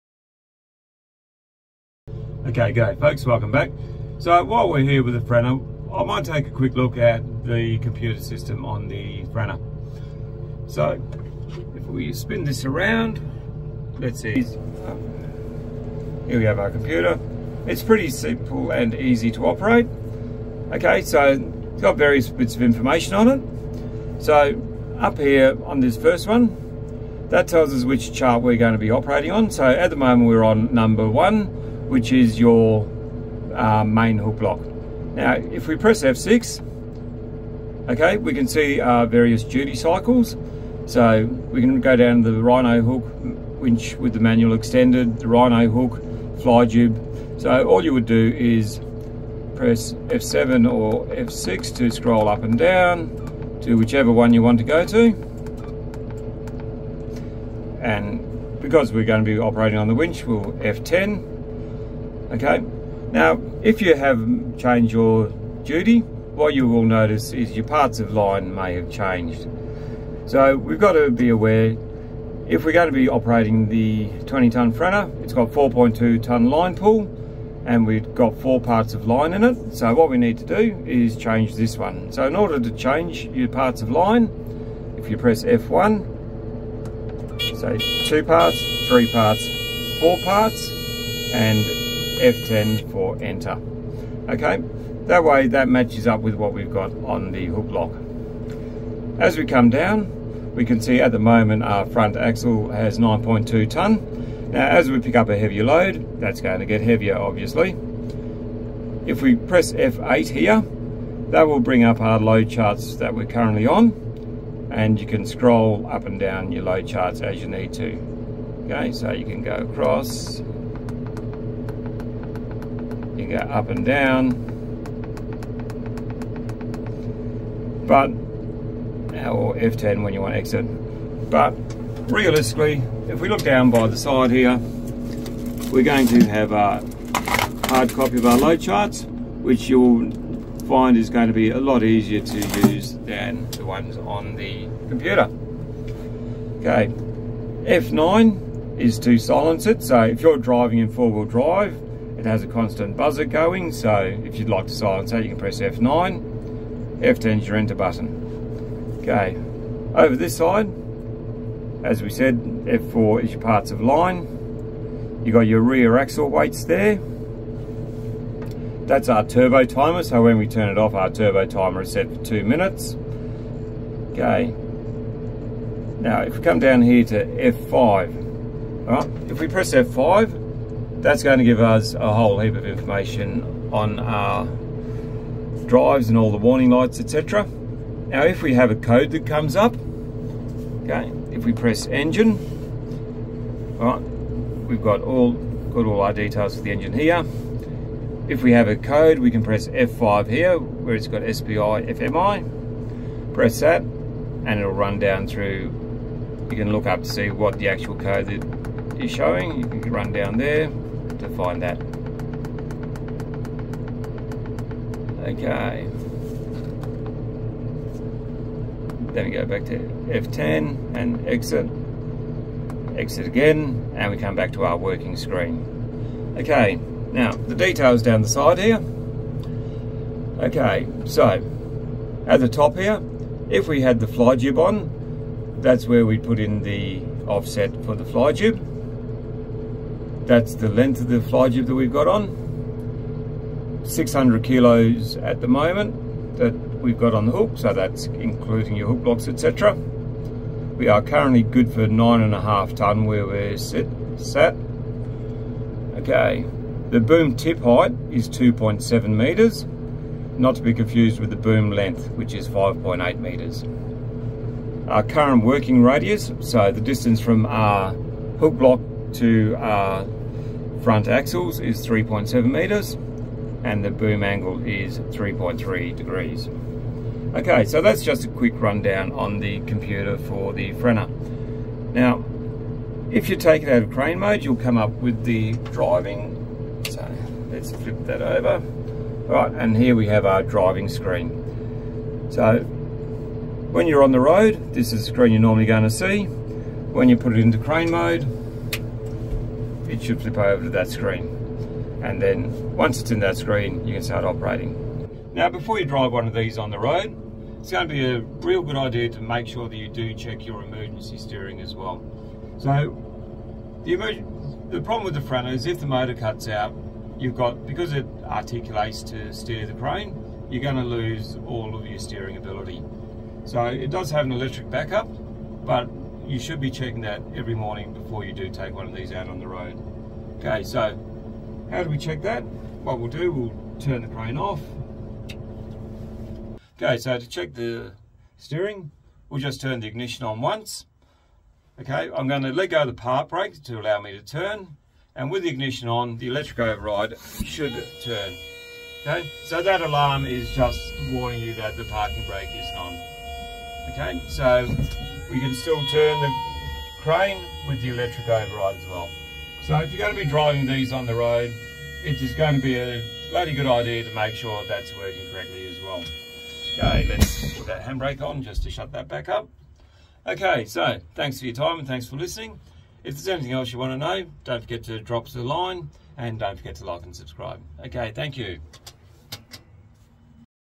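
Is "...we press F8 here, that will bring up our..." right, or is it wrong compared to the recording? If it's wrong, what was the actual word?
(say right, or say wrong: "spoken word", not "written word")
right.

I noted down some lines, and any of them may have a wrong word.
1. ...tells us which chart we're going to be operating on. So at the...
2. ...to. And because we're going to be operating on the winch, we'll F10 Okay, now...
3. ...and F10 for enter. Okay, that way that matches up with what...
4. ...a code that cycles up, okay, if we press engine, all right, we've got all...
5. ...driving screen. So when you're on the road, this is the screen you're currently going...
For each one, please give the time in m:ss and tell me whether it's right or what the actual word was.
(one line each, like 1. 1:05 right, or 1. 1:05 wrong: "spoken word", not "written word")
1. 0:27 right
2. 0:54 right
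3. 1:31 right
4. 3:08 wrong: "comes", not "cycles"
5. 4:50 wrong: "normally", not "currently".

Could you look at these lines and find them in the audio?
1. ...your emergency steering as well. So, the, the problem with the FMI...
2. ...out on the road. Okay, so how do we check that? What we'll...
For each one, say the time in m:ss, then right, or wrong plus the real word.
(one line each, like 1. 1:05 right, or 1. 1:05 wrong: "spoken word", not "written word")
1. 5:10 wrong: "Franna", not "FMI"
2. 5:29 right.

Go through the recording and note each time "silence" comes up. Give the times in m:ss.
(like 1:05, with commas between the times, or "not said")
2:29, 2:34.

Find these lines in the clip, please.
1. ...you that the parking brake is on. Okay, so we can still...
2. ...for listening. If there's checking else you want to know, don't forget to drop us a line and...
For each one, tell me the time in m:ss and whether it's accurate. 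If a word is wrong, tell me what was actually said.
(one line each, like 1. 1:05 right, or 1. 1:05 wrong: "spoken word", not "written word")
1. 5:51 right
2. 6:12 wrong: "anything", not "checking".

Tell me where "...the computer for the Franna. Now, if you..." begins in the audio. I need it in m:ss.
4:39.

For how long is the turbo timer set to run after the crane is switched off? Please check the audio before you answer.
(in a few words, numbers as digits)
two minutes.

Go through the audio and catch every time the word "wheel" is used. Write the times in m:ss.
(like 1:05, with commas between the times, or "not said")
2:30.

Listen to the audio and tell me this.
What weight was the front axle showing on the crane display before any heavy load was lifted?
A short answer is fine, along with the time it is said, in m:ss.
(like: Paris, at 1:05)
9.2 tonne, at 1:42.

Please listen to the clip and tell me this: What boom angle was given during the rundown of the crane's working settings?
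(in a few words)
3.3 degrees.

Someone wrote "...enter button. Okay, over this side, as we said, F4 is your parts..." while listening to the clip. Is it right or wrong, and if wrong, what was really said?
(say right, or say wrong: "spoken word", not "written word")
right.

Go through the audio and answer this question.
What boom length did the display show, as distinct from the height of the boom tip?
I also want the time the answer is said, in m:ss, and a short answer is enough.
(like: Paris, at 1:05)
5.8 meters, at 4:22.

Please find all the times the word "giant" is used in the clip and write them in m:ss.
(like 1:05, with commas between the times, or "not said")
not said.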